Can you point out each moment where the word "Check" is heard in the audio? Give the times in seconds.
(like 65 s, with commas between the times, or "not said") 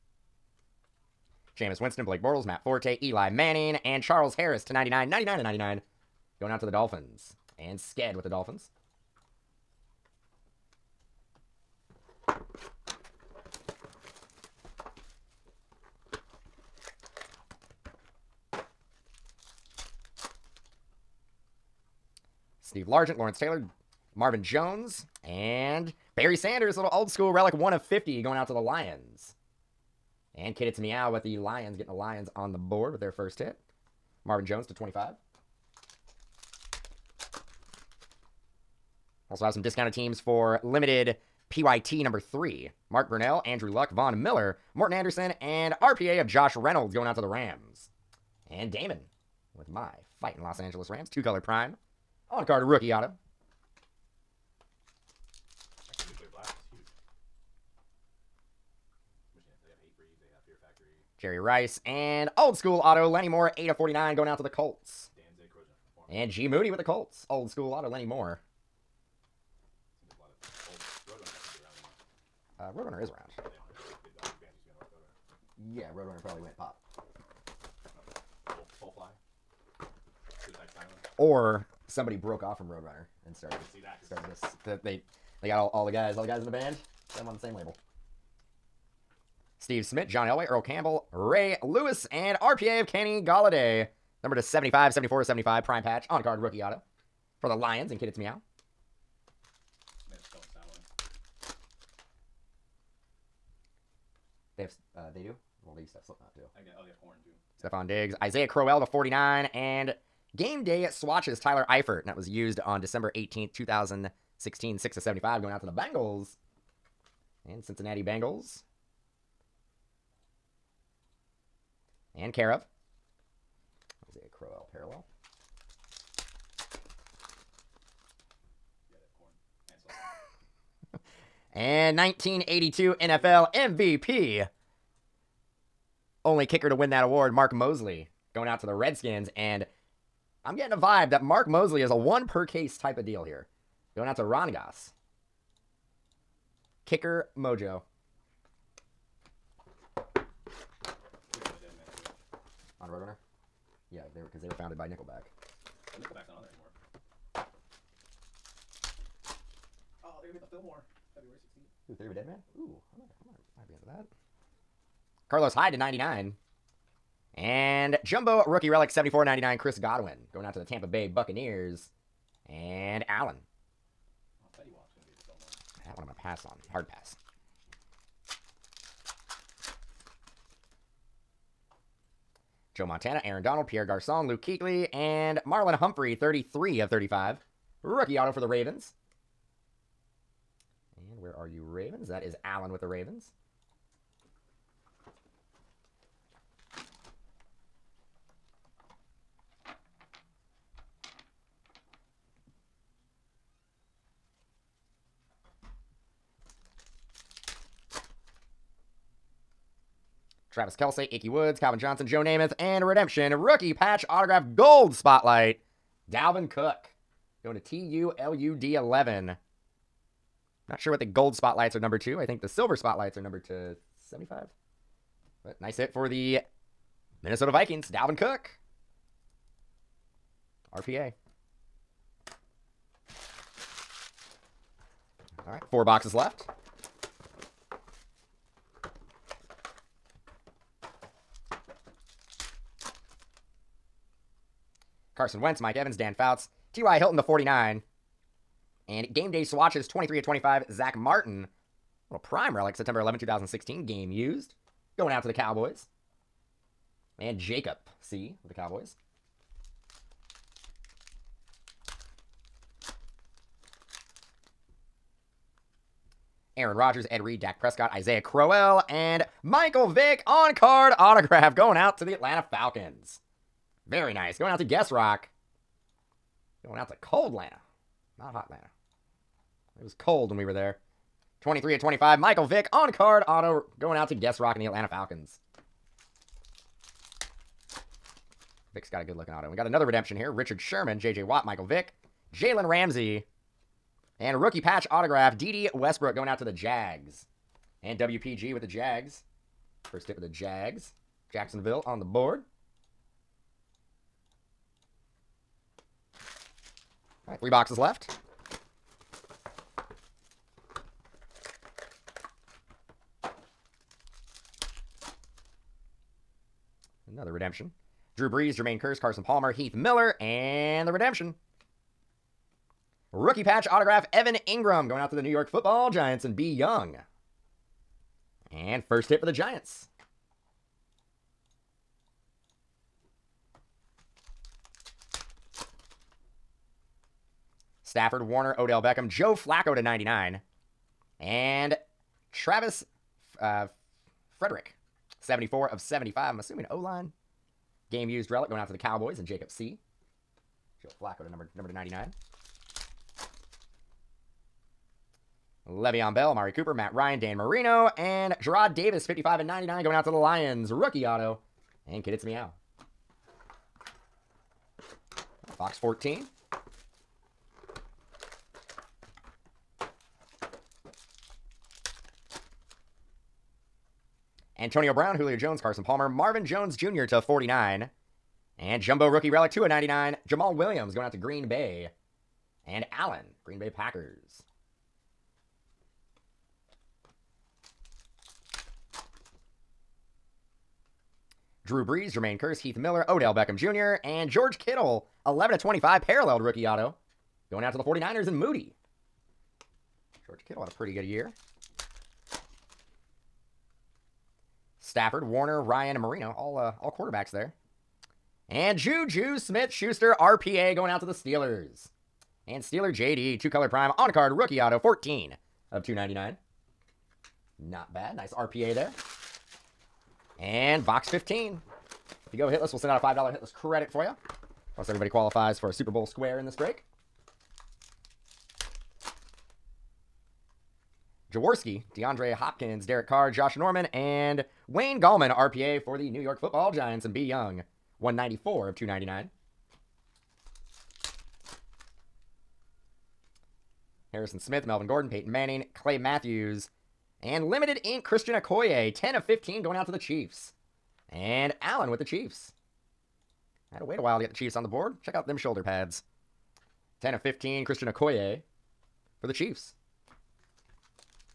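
455 s.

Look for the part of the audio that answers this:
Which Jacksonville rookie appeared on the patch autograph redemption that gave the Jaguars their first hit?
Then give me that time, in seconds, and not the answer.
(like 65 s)
295 s.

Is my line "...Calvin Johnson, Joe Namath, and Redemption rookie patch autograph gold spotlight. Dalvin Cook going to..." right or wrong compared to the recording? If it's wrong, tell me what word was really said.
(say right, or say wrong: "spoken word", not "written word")
right.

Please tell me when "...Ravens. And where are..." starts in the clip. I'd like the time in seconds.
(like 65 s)
188 s.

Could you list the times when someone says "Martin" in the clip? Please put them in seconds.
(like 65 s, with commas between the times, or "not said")
250 s.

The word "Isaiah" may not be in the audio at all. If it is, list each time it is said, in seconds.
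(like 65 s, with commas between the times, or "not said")
108 s, 267 s.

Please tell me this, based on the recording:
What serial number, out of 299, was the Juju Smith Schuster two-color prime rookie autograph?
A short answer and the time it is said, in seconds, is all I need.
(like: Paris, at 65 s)
14, at 414 s.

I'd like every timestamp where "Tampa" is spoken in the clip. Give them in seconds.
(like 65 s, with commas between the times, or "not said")
170 s.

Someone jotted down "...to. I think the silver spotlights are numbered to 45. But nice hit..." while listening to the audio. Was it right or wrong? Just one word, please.
wrong.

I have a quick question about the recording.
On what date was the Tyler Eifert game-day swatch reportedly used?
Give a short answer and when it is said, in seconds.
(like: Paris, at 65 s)
December 18th, 2016, at 112 s.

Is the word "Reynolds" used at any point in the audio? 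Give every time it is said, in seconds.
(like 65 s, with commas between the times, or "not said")
46 s.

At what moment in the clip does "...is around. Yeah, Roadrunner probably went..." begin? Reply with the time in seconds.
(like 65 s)
73 s.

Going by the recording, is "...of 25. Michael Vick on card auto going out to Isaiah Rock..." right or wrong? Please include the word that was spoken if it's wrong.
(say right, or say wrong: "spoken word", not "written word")
wrong: "Guess", not "Isaiah".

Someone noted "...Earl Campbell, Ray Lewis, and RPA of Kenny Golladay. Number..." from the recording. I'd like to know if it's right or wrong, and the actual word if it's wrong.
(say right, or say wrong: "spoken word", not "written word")
right.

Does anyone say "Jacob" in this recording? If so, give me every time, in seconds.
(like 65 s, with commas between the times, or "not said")
257 s, 349 s.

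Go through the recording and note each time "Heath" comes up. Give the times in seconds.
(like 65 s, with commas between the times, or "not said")
319 s, 392 s.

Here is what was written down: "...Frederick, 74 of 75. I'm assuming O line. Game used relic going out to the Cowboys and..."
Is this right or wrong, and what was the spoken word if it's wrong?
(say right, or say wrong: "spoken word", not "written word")
right.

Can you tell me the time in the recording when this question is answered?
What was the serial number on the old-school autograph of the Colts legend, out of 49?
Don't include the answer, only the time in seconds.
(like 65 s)
63 s.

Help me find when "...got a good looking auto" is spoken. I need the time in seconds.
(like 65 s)
288 s.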